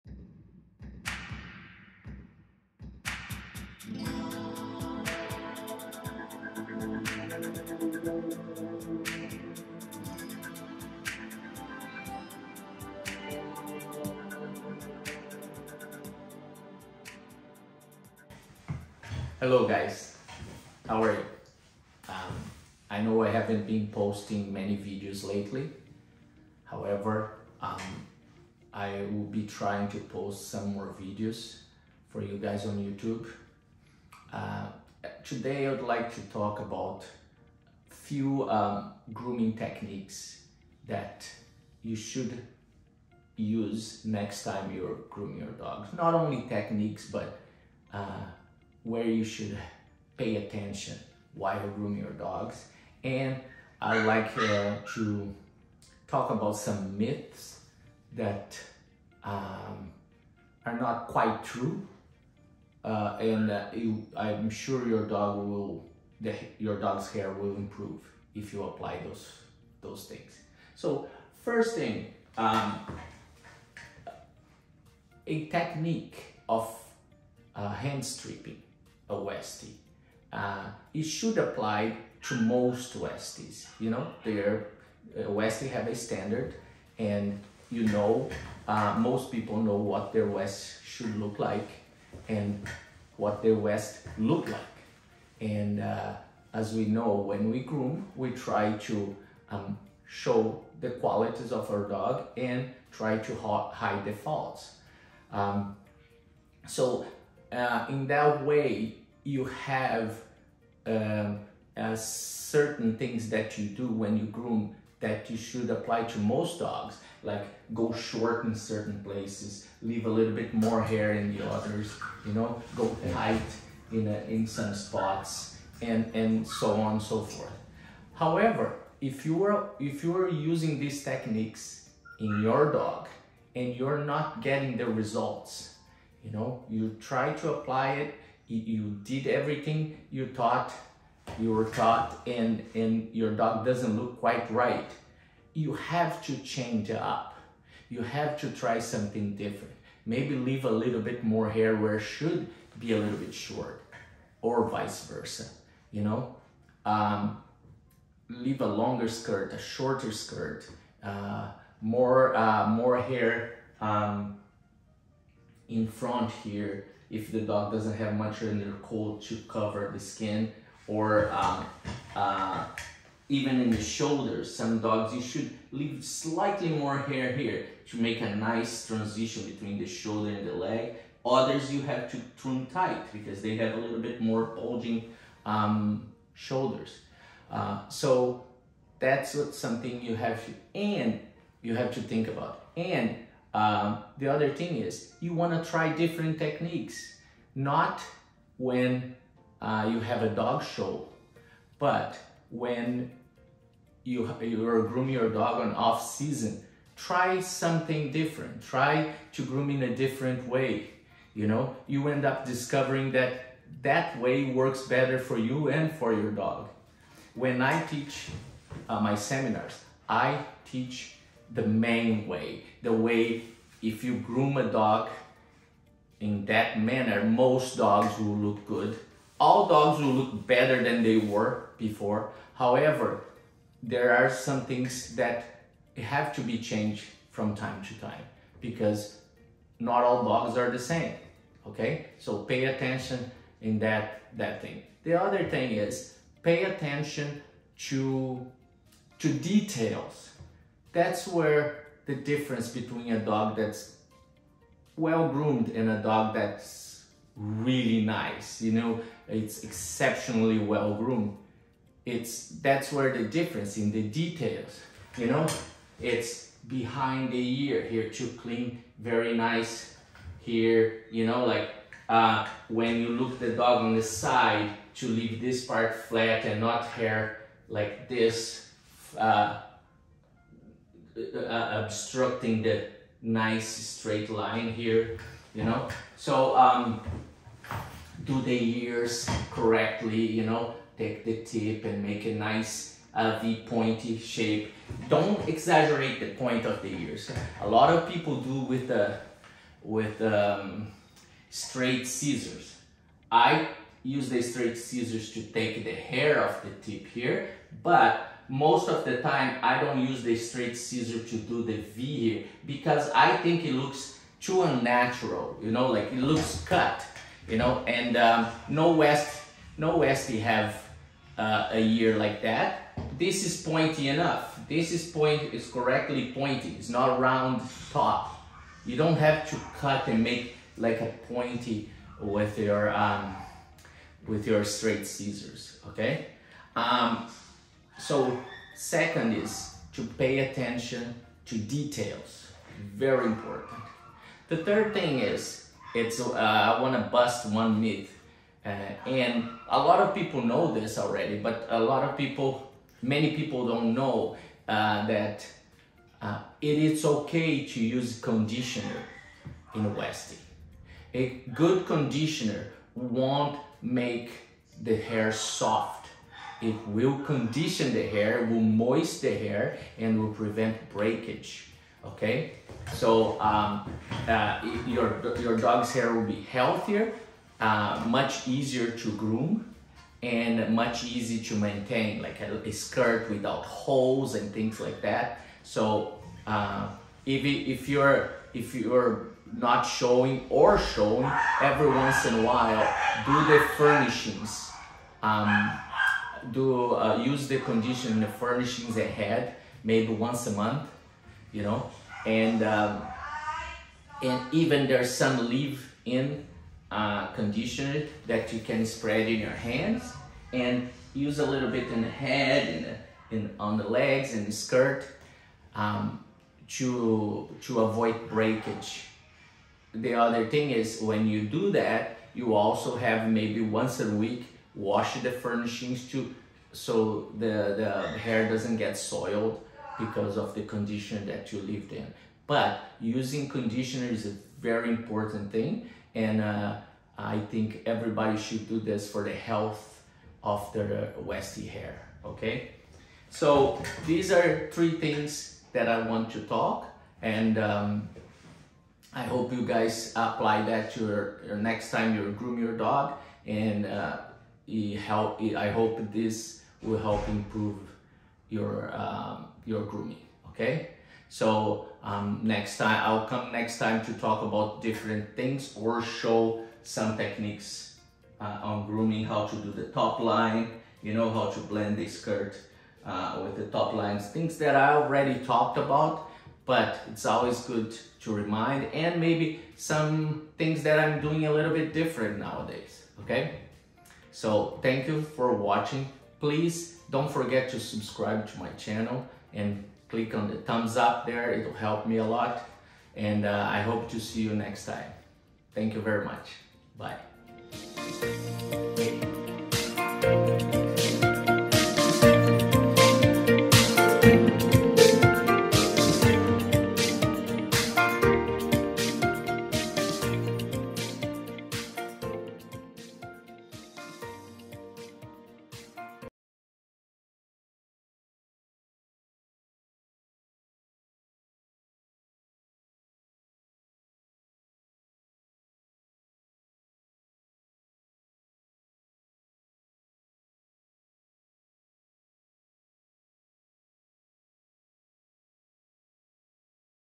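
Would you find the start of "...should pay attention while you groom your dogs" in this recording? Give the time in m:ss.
0:49.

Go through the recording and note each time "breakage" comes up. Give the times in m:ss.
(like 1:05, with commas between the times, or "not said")
6:10, 6:58.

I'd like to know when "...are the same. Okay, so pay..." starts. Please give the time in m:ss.
4:00.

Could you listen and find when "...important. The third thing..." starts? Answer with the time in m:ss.
5:43.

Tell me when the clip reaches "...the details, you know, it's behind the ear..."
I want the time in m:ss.
4:23.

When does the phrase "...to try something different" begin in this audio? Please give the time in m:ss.
2:28.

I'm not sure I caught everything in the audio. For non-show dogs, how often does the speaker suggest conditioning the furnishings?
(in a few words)
once a month.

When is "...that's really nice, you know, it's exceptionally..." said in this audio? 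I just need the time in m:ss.
4:16.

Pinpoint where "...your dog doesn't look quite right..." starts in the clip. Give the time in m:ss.
2:23.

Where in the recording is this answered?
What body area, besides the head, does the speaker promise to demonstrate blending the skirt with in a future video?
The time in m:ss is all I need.
7:53.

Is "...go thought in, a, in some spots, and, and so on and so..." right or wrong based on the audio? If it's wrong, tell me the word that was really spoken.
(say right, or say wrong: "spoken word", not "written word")
wrong: "tight", not "thought".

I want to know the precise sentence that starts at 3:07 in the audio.
Uh, so that's what something you have to, and you have to think about.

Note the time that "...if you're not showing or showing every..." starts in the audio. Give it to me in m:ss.
6:28.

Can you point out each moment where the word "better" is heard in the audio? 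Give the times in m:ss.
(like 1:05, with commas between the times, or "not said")
3:34, 3:50.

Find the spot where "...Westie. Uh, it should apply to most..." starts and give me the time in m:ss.
1:19.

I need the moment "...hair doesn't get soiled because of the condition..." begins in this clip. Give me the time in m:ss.
7:08.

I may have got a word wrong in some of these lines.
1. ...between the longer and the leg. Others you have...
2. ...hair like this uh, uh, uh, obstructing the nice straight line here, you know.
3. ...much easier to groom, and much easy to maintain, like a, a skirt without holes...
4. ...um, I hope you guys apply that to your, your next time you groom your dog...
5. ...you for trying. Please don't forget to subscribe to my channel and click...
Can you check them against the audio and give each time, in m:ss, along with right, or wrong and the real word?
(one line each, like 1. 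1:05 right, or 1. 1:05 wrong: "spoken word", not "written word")
1. 2:59 wrong: "shoulder", not "longer"
2. 4:36 right
3. 6:18 right
4. 7:27 right
5. 8:05 wrong: "watching", not "trying".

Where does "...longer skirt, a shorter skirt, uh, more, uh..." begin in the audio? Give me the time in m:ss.
2:38.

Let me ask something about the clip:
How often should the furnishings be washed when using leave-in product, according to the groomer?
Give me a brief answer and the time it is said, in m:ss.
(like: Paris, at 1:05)
once a week, at 7:03.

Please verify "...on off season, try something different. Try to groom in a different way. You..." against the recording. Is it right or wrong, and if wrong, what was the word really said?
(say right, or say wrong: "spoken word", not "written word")
right.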